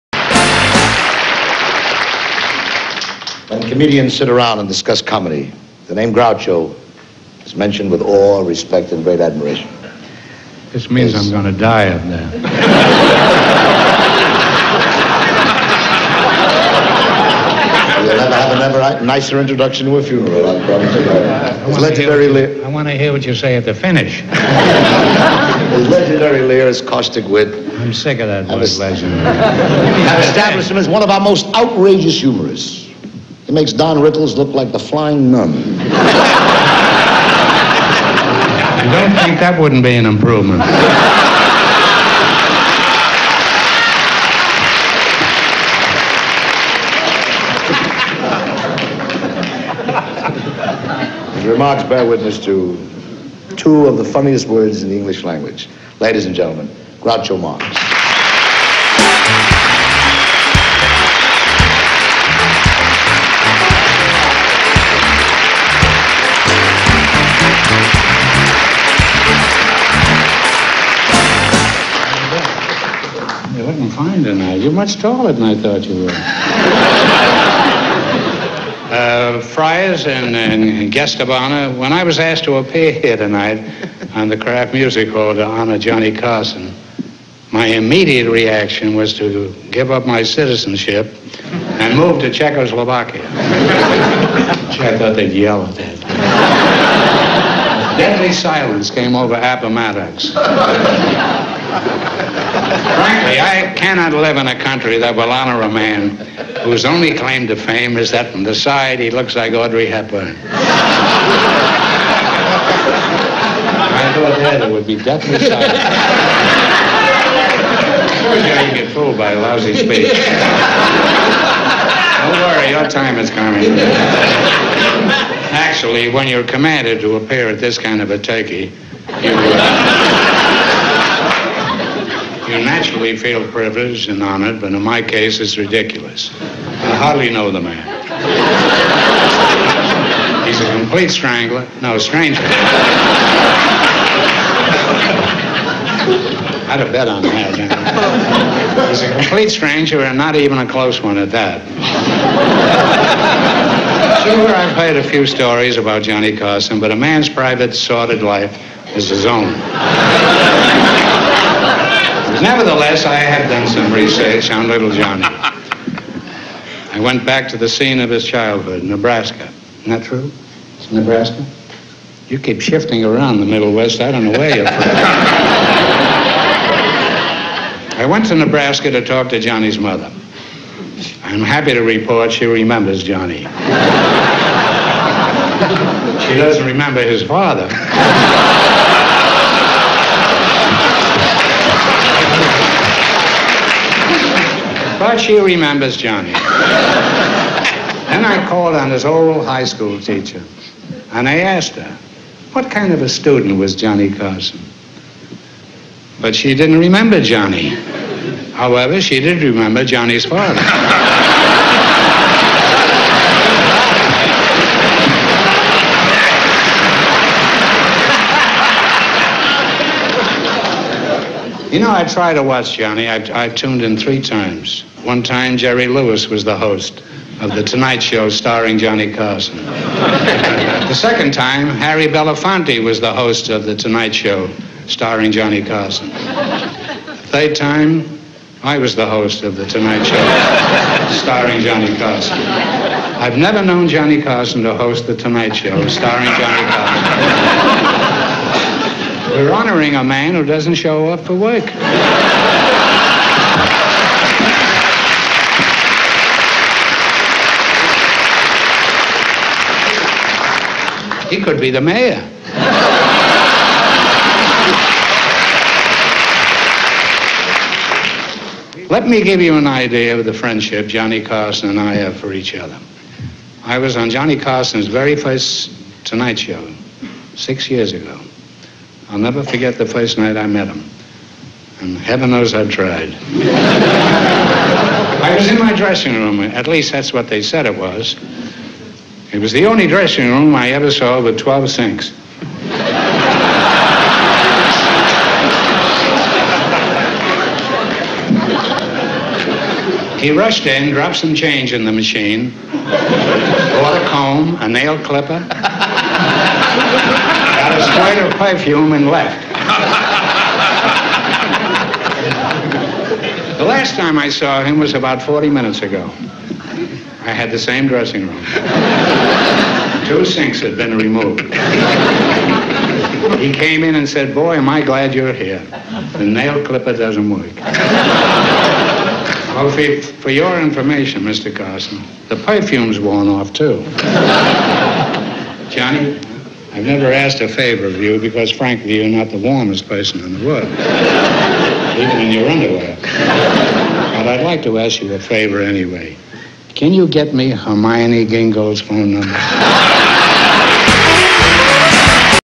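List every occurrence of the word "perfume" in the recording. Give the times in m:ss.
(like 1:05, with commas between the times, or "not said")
5:08, 5:32.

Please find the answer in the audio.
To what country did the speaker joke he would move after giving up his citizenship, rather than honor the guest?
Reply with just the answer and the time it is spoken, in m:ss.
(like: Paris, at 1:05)
Czechoslovakia, at 1:32.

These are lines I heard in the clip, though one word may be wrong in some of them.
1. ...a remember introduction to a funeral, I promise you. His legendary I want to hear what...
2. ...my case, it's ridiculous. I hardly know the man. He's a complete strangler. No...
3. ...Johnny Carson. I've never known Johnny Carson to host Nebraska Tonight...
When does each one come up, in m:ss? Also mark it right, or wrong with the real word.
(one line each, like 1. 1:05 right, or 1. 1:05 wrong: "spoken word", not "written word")
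1. 0:19 wrong: "nicer", not "remember"
2. 2:14 right
3. 4:01 wrong: "The", not "Nebraska".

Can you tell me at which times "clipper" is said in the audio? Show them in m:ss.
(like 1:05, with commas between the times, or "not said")
5:05, 5:26.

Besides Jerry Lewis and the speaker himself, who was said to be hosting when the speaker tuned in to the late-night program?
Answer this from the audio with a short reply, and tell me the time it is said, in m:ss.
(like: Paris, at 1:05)
Harry Belafonte, at 3:51.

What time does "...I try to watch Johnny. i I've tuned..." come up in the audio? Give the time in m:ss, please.
3:41.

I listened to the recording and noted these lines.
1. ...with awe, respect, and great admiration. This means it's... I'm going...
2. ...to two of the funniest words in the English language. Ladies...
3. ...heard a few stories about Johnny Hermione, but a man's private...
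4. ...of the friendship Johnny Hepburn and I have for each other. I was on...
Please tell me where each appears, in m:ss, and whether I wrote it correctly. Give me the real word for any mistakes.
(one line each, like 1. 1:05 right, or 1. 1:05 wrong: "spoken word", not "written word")
1. 0:07 right
2. 0:52 right
3. 2:34 wrong: "Carson", not "Hermione"
4. 4:30 wrong: "Carson", not "Hepburn".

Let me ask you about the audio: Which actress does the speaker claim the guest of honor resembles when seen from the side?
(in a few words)
Audrey Hepburn.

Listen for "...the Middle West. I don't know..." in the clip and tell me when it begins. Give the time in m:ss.
2:53.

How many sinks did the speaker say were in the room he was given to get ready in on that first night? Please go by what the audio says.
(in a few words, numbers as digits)
12.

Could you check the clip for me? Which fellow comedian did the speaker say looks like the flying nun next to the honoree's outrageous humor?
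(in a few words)
Don Rickles.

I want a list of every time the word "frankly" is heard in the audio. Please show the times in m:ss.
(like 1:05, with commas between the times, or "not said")
1:42, 5:38.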